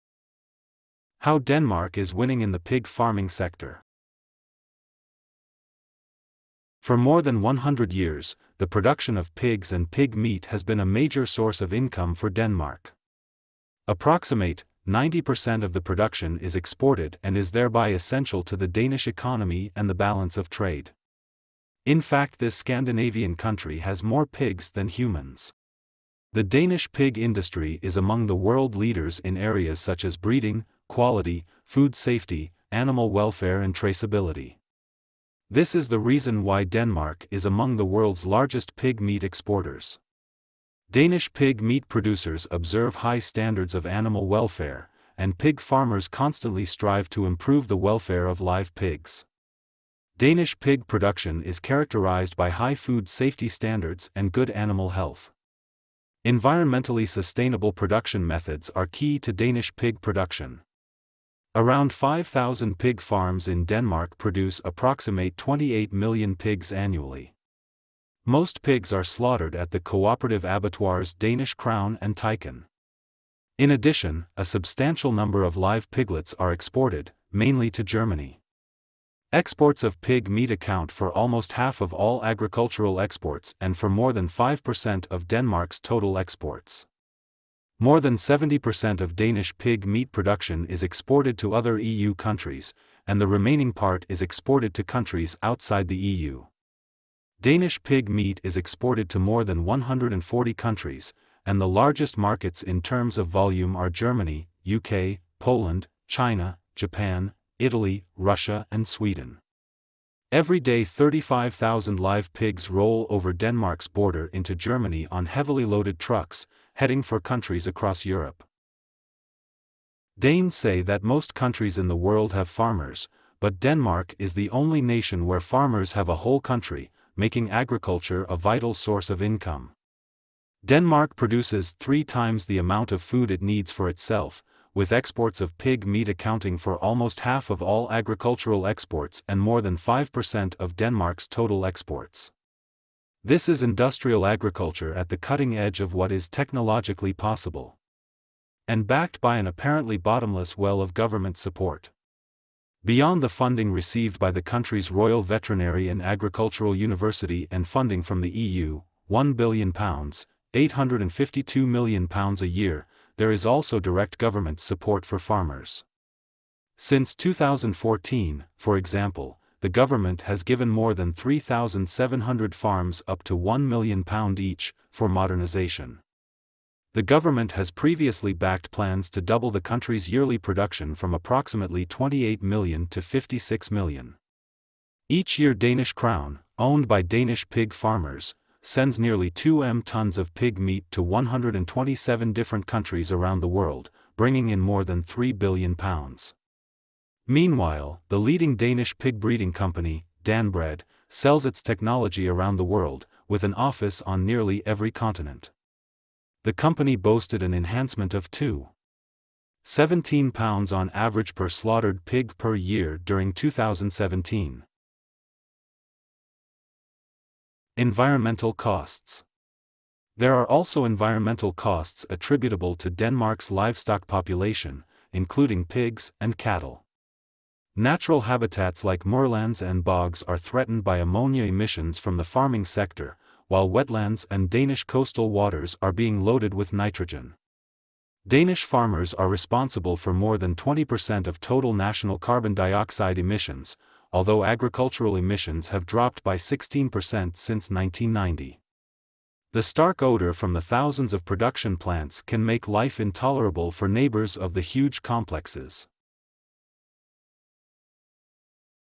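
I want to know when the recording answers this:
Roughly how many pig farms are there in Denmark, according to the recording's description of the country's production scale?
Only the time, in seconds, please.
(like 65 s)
61 s.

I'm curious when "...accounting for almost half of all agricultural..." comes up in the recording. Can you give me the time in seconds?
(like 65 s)
136 s.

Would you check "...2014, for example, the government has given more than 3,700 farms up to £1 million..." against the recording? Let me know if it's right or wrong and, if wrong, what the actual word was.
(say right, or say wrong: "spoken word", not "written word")
right.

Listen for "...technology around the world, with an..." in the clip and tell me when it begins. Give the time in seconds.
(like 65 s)
201 s.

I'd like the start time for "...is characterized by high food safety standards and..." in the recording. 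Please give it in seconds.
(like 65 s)
51 s.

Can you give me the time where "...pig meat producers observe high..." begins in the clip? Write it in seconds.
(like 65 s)
41 s.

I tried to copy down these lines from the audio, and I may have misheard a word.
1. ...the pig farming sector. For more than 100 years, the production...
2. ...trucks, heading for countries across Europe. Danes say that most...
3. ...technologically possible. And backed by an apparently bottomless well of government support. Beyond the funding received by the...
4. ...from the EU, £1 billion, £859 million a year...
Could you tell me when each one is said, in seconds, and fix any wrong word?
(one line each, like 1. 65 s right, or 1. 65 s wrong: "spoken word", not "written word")
1. 2 s right
2. 115 s right
3. 146 s right
4. 158 s wrong: "852", not "859".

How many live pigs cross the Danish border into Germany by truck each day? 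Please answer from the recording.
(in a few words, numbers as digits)
35,000.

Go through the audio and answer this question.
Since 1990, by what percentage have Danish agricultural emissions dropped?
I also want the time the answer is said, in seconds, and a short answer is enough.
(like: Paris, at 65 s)
16%, at 246 s.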